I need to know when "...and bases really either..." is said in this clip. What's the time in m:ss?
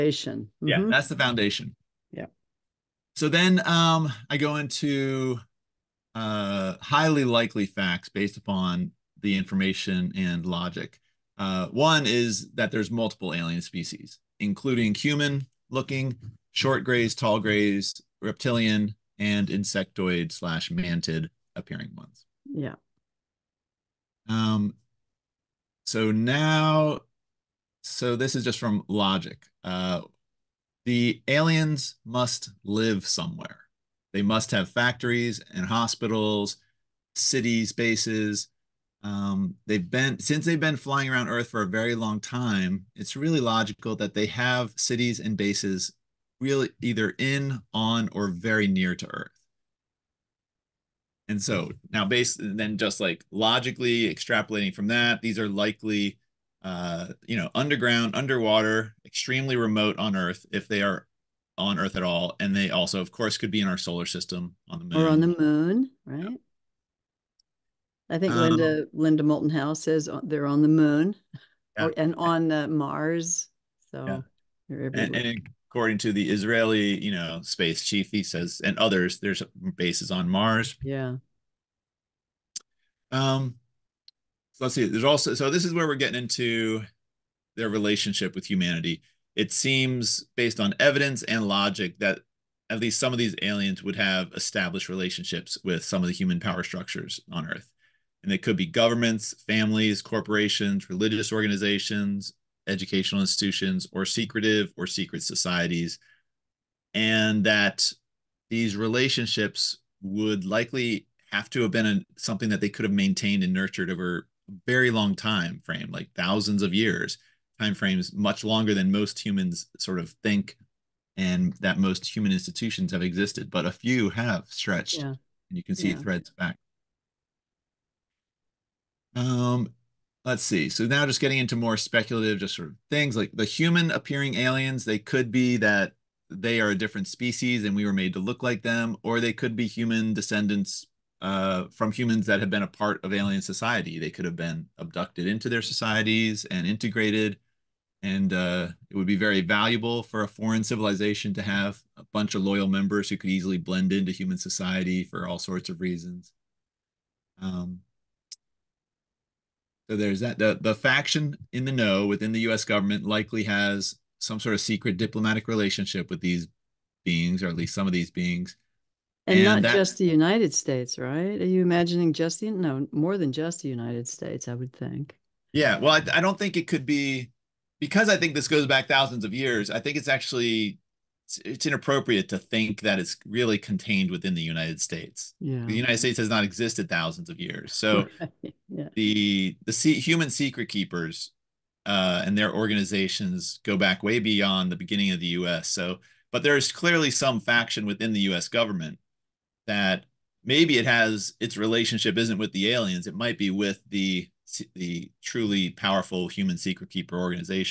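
0:45.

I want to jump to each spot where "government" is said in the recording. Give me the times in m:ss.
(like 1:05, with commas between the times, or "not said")
1:38, 2:42, 3:18.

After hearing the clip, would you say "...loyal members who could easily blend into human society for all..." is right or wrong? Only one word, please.
right.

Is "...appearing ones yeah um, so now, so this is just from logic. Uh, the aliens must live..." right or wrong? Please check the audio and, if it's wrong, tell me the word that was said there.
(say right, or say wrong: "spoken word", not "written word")
right.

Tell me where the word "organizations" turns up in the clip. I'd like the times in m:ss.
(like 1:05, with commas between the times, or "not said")
1:41, 3:12, 3:27.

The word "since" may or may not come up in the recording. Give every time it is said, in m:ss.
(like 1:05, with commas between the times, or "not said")
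0:40.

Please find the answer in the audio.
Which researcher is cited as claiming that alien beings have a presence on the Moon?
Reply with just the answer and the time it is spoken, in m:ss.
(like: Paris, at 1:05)
Linda Moulton Howe, at 1:08.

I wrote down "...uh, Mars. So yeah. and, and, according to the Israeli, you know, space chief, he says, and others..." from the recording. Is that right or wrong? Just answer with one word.
right.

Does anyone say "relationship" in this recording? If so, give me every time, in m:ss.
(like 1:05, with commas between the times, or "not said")
1:27, 1:34, 1:48, 2:45, 3:21.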